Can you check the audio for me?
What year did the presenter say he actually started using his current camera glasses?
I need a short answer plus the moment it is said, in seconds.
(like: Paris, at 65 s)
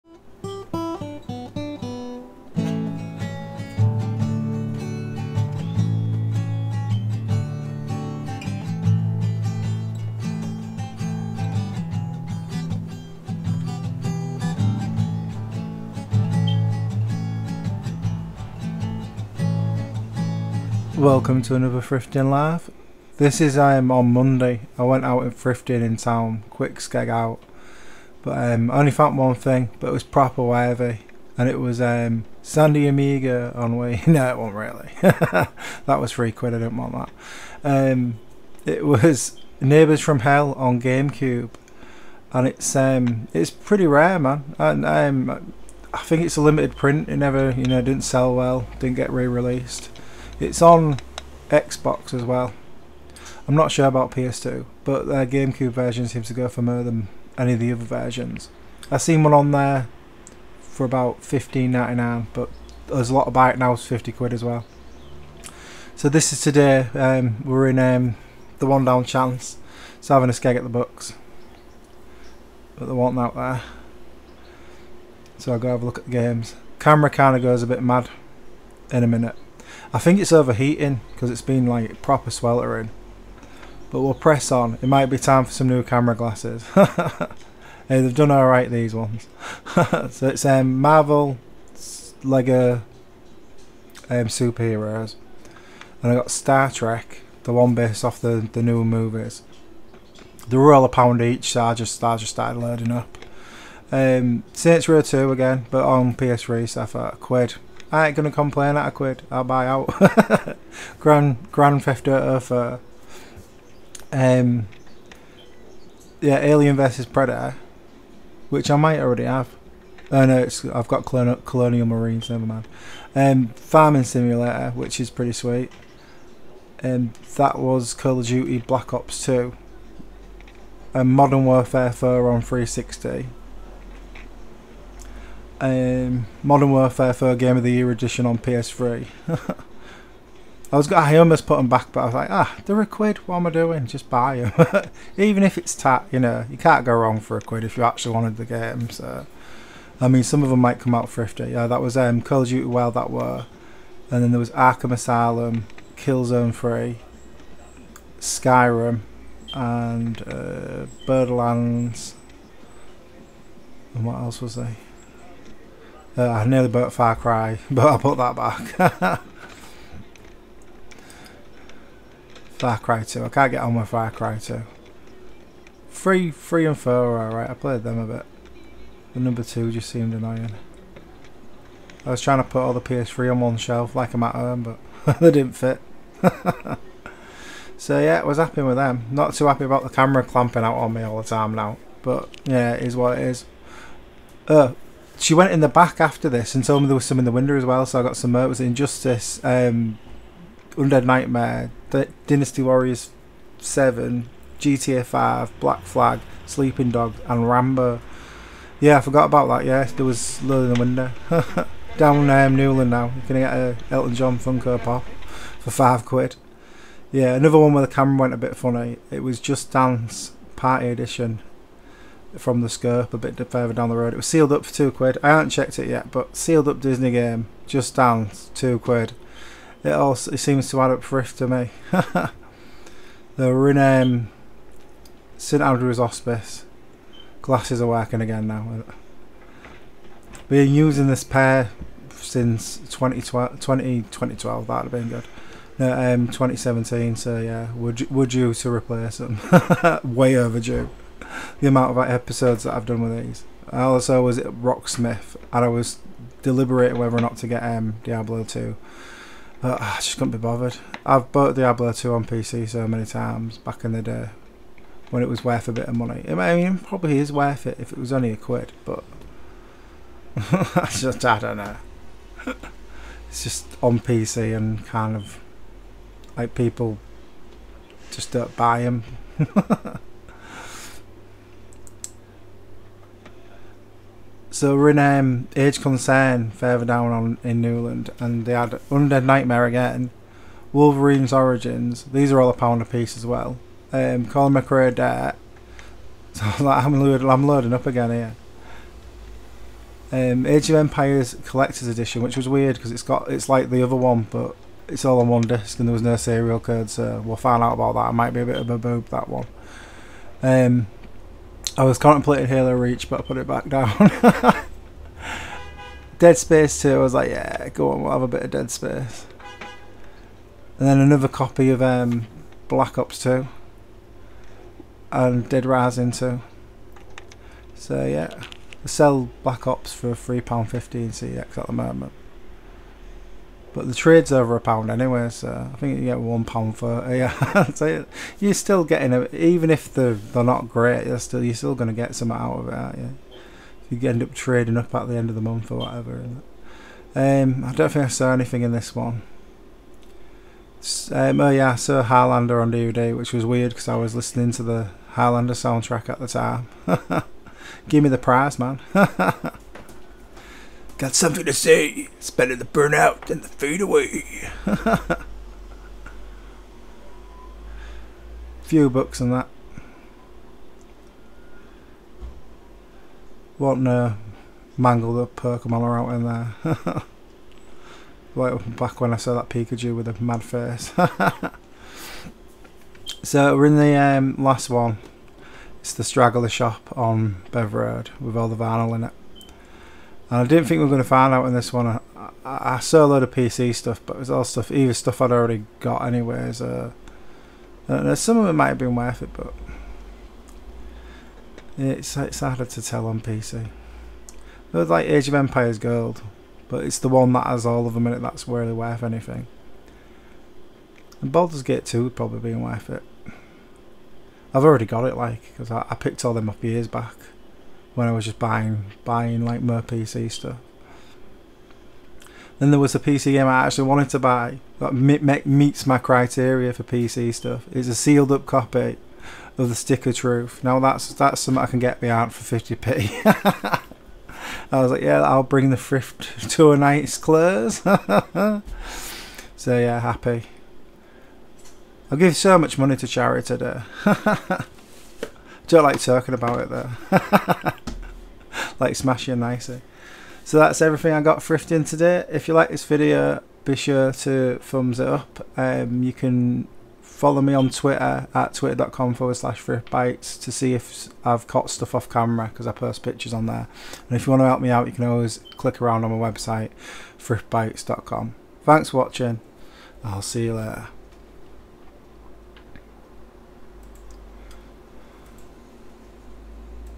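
2017, at 246 s.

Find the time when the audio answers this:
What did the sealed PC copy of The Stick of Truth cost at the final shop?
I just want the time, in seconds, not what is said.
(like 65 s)
432 s.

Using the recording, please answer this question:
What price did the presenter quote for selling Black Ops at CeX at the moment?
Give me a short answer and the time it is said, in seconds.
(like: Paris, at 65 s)
£3.15, at 330 s.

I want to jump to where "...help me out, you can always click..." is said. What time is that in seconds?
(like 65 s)
464 s.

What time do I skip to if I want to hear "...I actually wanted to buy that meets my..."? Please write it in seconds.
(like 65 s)
423 s.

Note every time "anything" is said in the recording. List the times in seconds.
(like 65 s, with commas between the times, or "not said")
348 s, 409 s.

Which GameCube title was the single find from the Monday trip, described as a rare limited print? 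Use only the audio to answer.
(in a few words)
Neighbours from Hell.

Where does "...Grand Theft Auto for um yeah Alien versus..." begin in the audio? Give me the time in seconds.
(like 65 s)
111 s.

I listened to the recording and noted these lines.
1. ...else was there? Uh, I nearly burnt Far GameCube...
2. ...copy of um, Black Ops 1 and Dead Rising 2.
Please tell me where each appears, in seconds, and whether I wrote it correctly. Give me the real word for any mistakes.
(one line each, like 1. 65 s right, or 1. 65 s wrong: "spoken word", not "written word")
1. 164 s wrong: "Cry", not "GameCube"
2. 321 s wrong: "2", not "1".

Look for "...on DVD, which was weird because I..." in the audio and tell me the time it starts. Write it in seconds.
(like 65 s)
352 s.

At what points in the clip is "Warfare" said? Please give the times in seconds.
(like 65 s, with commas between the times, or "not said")
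131 s, 136 s.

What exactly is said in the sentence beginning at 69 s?
So having a skeg at the books, but there was not out there.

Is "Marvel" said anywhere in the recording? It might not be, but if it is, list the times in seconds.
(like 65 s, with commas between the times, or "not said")
90 s.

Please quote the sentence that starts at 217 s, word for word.
Yeah, another one where the camera went a bit funny.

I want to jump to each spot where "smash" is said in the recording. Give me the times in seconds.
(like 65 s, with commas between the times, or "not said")
448 s.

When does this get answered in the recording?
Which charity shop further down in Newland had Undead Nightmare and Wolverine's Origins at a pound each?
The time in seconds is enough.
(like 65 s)
285 s.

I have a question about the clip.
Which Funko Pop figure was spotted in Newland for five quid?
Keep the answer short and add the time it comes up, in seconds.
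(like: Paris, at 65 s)
Elton John, at 213 s.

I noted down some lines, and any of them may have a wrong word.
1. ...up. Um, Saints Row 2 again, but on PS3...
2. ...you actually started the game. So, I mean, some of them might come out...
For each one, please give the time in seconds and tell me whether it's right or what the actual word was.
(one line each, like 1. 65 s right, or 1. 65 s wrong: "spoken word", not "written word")
1. 102 s right
2. 147 s wrong: "wanted", not "started".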